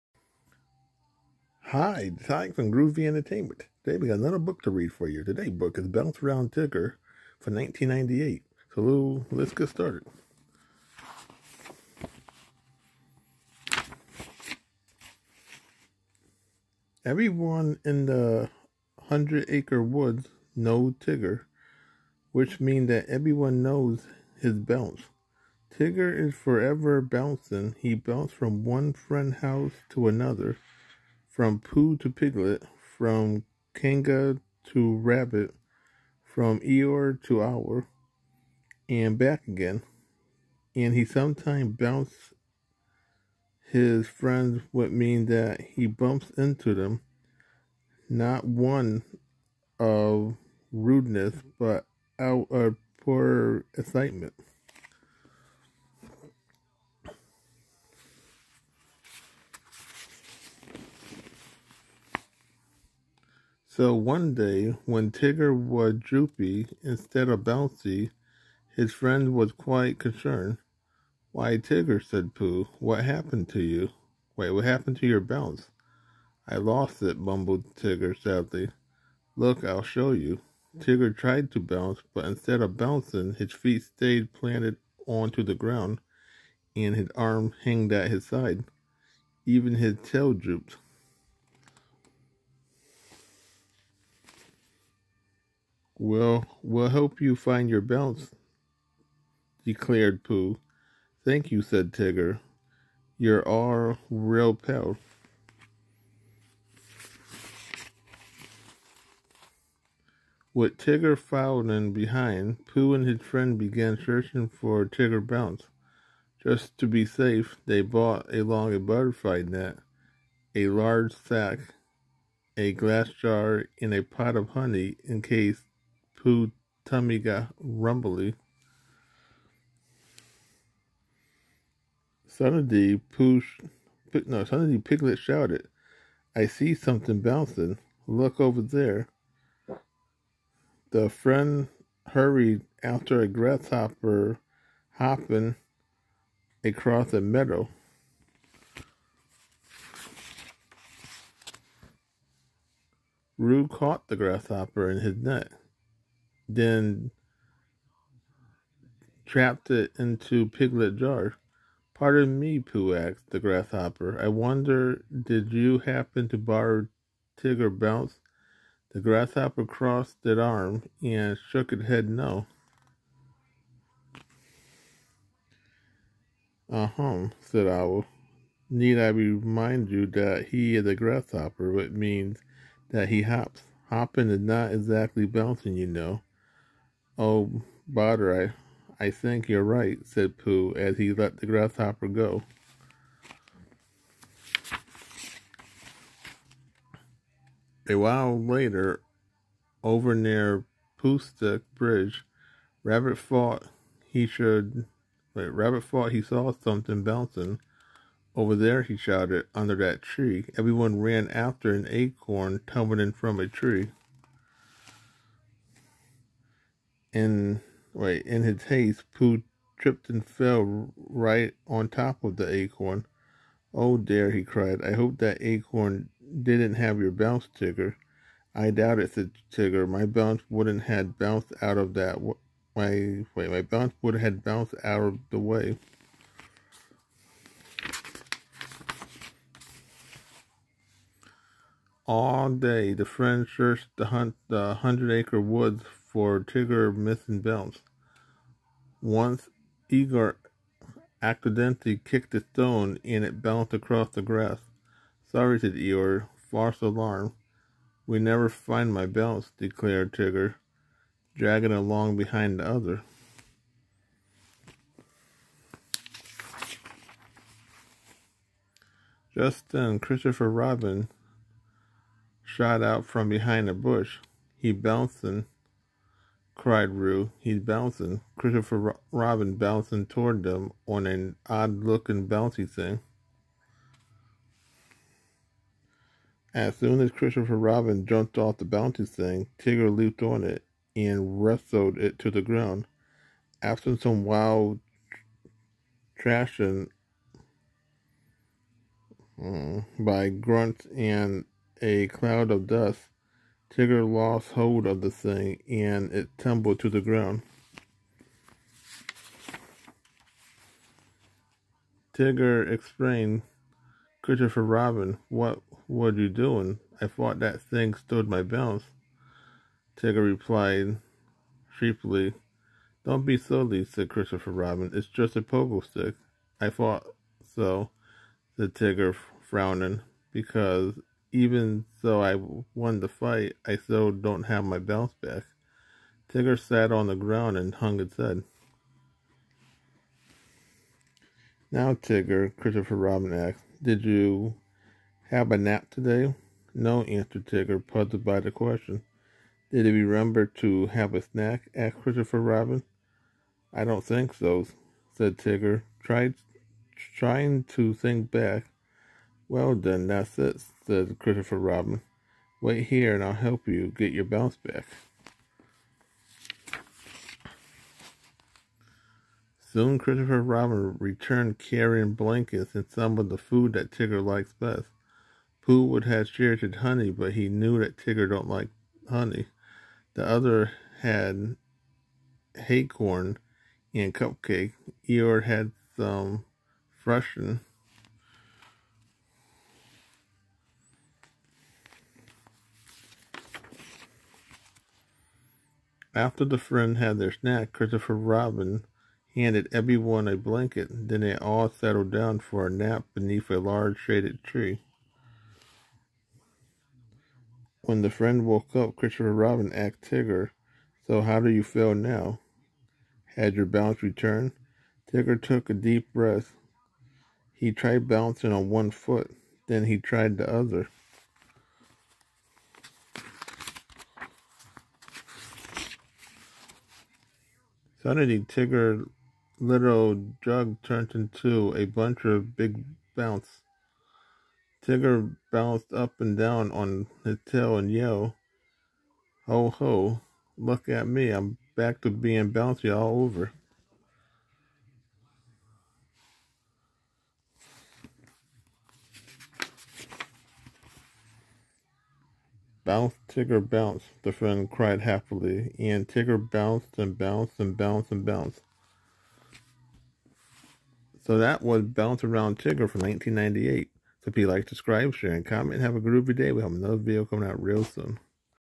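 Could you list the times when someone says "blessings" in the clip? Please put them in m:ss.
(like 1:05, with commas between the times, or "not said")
not said.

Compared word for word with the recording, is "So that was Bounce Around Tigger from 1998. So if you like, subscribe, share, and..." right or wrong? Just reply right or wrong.
right.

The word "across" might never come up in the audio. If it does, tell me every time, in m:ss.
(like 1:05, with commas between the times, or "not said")
2:26, 4:13.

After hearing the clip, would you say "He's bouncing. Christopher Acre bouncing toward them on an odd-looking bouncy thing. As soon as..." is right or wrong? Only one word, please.
wrong.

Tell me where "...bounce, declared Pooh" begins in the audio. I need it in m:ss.
1:37.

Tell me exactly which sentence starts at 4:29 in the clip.
Just then, Christopher Robin shot out from behind a bush.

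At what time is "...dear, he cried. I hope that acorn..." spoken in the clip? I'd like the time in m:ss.
3:43.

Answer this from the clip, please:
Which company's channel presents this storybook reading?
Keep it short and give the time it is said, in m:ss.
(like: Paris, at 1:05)
Groovy Entertainment, at 0:02.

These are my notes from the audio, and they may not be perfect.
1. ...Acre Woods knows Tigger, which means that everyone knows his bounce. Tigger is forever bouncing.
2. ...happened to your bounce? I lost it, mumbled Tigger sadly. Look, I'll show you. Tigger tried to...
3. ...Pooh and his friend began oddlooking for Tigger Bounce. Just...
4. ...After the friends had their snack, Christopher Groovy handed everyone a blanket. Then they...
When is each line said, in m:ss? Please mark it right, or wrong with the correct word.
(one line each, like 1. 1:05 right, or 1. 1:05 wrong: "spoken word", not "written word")
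1. 0:19 right
2. 1:14 right
3. 1:52 wrong: "searching", not "oddlooking"
4. 6:36 wrong: "Robin", not "Groovy".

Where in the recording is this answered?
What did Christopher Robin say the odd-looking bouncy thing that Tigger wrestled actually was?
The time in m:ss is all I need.
5:25.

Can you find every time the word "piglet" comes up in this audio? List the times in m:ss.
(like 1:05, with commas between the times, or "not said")
0:32, 2:14, 2:40.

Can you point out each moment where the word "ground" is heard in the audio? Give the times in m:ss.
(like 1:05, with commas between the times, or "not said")
1:25, 4:52, 5:06, 5:37.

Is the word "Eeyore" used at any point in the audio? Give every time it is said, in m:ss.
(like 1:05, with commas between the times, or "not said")
0:36, 4:09, 4:15, 6:25.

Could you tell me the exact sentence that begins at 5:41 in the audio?
Now, Tigger, Christopher Robin asked, did you have a nap today?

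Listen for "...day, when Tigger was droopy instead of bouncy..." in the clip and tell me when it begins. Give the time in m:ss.
1:04.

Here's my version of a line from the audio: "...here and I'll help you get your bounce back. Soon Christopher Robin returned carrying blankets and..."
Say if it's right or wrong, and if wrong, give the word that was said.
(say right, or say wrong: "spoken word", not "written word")
right.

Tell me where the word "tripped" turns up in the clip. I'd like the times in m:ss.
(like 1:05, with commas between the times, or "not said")
3:39.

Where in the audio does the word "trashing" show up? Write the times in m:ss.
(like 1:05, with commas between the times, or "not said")
4:56.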